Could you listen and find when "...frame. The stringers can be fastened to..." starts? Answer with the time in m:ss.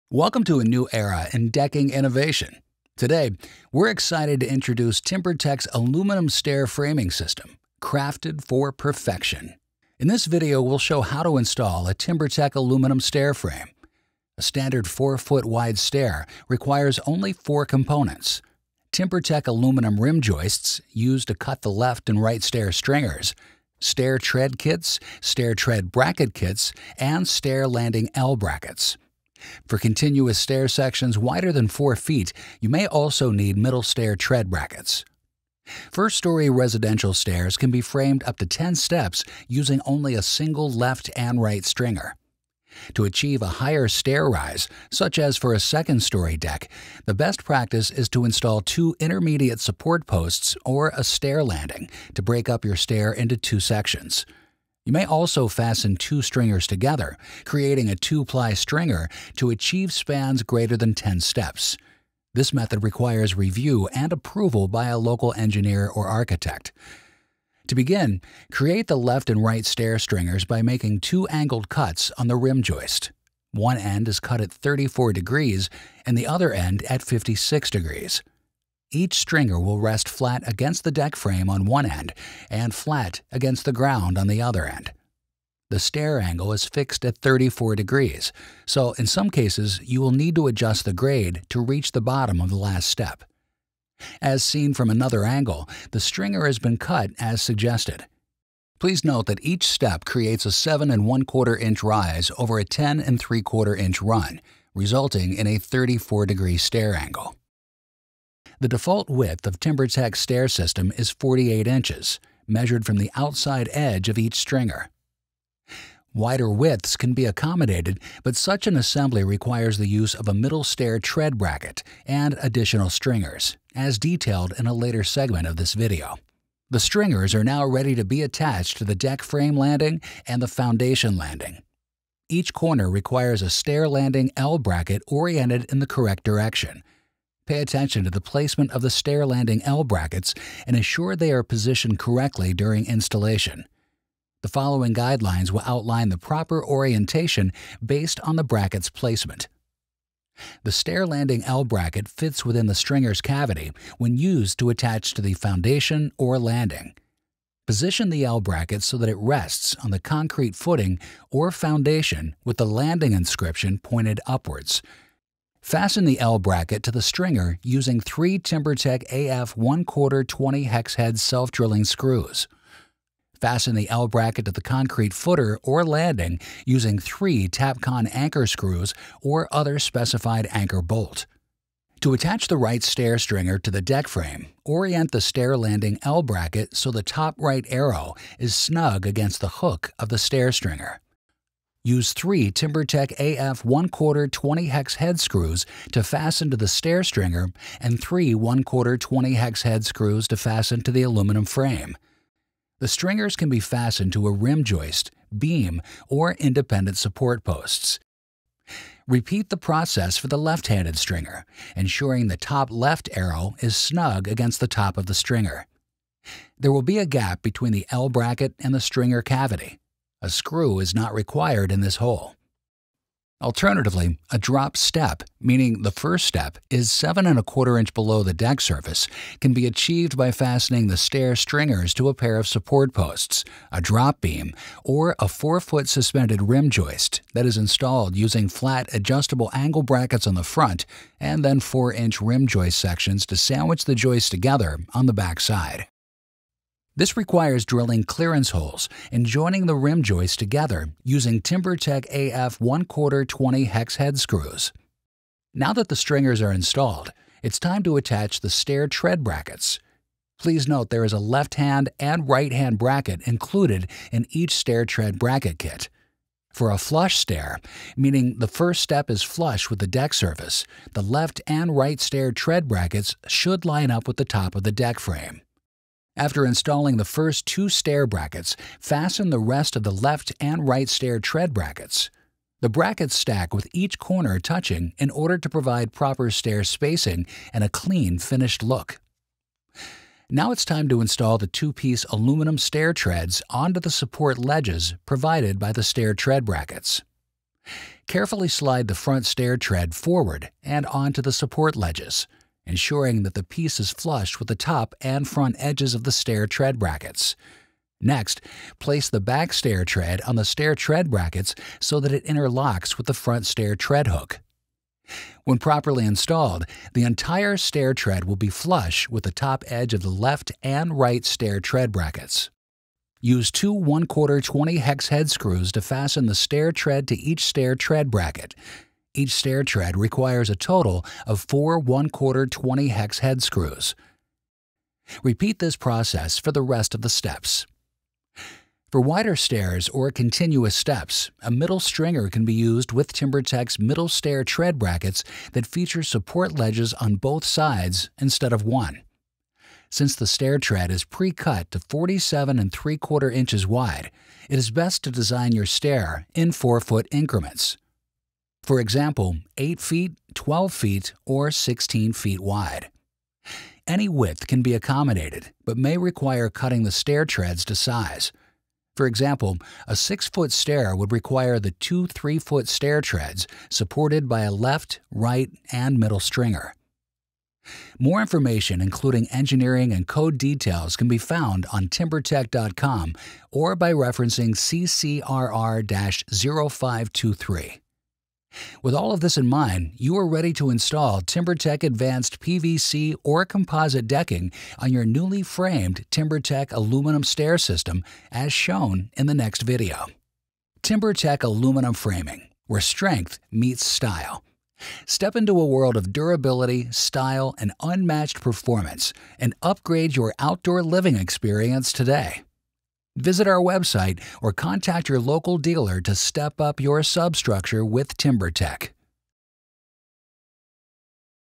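3:21.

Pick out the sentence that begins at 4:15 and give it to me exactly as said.
Now that the stringers are installed, it's time to attach the stair tread brackets.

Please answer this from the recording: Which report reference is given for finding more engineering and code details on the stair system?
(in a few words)
CCRR 0523.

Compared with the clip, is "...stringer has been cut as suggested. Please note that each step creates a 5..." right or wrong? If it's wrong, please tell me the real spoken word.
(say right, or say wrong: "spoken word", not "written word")
wrong: "7", not "5".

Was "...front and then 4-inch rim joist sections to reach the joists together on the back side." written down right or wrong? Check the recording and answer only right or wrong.
wrong.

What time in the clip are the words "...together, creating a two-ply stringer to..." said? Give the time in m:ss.
0:56.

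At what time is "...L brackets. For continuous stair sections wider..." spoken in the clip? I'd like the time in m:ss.
0:28.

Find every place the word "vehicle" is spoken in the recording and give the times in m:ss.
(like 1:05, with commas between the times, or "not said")
not said.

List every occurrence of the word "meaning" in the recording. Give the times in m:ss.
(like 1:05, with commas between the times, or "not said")
3:45, 4:27.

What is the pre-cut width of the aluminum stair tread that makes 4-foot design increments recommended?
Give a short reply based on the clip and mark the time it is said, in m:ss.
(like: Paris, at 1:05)
47 3/4 inches, at 5:51.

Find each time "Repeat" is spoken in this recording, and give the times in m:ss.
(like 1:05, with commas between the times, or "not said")
3:29, 5:35.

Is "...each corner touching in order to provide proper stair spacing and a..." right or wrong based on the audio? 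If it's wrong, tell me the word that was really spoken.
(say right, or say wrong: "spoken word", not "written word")
right.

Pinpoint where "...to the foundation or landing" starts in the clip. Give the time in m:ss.
2:35.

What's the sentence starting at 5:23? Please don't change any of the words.
Use two 1 quarter 20 hex head screws to fasten the stair tread to each stair tread bracket.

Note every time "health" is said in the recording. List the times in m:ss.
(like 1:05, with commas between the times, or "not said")
not said.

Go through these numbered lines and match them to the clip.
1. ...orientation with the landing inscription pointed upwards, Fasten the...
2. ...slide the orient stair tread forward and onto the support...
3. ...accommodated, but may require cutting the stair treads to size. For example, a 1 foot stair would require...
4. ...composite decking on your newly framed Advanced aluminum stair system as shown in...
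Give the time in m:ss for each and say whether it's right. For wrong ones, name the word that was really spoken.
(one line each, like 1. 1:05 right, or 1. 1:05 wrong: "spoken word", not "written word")
1. 2:41 wrong: "foundation", not "orientation"
2. 4:58 wrong: "front", not "orient"
3. 6:04 wrong: "6", not "1"
4. 6:33 wrong: "TimberTech", not "Advanced".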